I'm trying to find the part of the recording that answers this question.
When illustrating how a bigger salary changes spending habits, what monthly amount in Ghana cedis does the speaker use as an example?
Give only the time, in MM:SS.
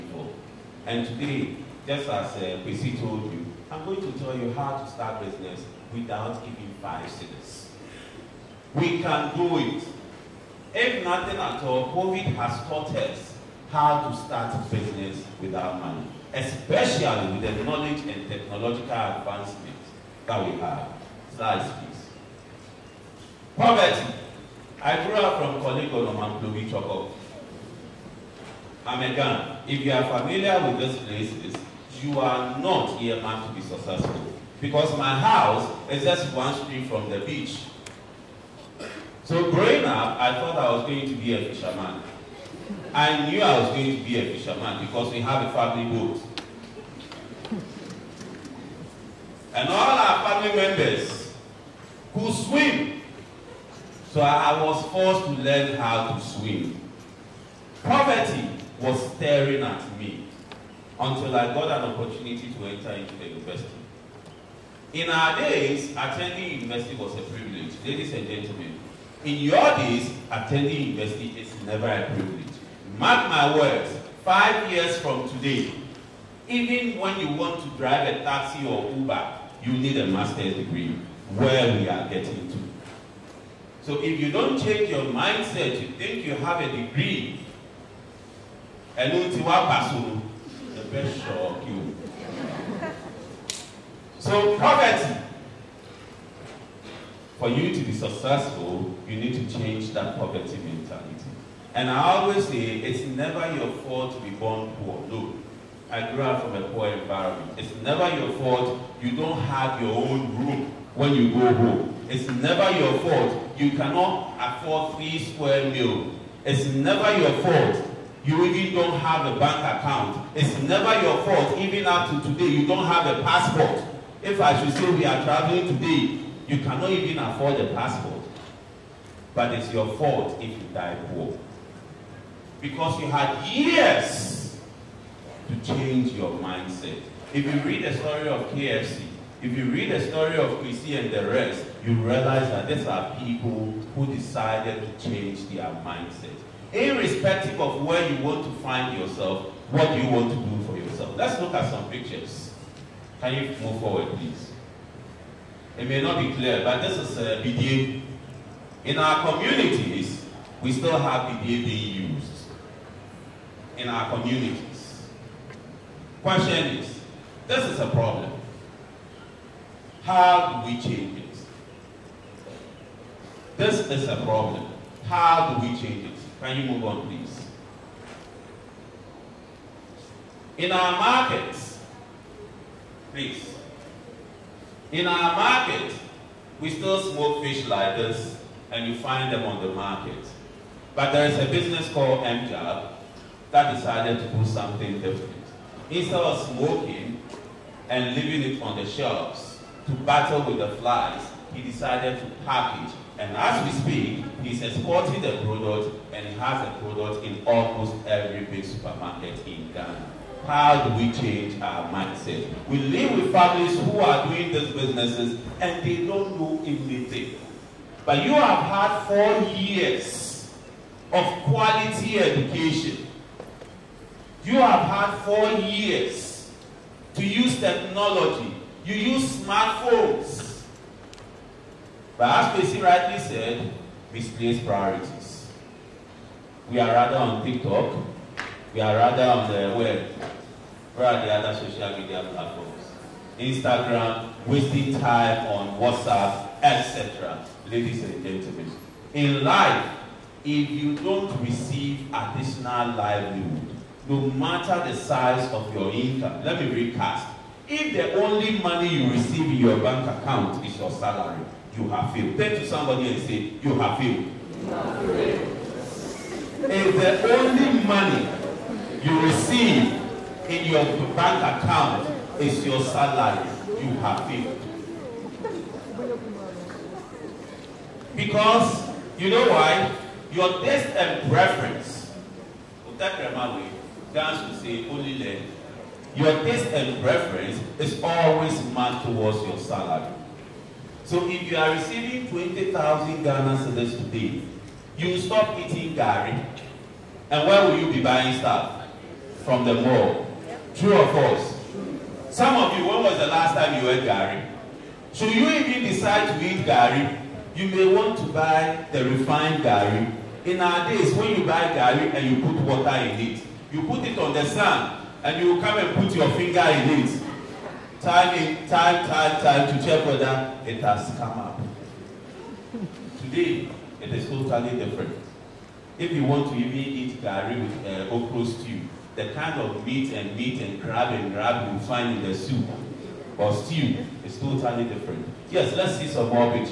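04:52.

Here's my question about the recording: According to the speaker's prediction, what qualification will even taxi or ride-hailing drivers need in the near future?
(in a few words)
master's degree.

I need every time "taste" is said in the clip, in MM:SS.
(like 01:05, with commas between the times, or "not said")
04:40, 04:46.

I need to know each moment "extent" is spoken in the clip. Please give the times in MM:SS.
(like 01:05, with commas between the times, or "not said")
not said.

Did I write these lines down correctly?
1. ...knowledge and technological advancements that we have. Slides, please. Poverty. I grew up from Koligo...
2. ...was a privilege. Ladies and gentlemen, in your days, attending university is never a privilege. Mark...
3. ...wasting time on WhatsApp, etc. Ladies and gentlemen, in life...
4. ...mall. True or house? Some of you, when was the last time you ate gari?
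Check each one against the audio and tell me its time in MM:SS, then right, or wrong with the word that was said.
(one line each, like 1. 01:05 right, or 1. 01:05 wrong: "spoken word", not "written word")
1. 00:17 right
2. 01:06 right
3. 04:04 right
4. 04:59 wrong: "false", not "house".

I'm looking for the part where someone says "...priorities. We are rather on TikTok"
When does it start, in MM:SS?
03:54.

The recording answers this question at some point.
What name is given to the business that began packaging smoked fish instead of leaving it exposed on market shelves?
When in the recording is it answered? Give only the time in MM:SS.
03:12.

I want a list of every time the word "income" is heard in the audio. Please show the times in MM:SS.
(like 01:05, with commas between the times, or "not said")
04:15.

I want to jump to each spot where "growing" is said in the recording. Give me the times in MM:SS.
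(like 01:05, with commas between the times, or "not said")
00:39.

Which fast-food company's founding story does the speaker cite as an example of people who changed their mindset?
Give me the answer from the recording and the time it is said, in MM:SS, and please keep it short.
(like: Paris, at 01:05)
KFC, at 02:18.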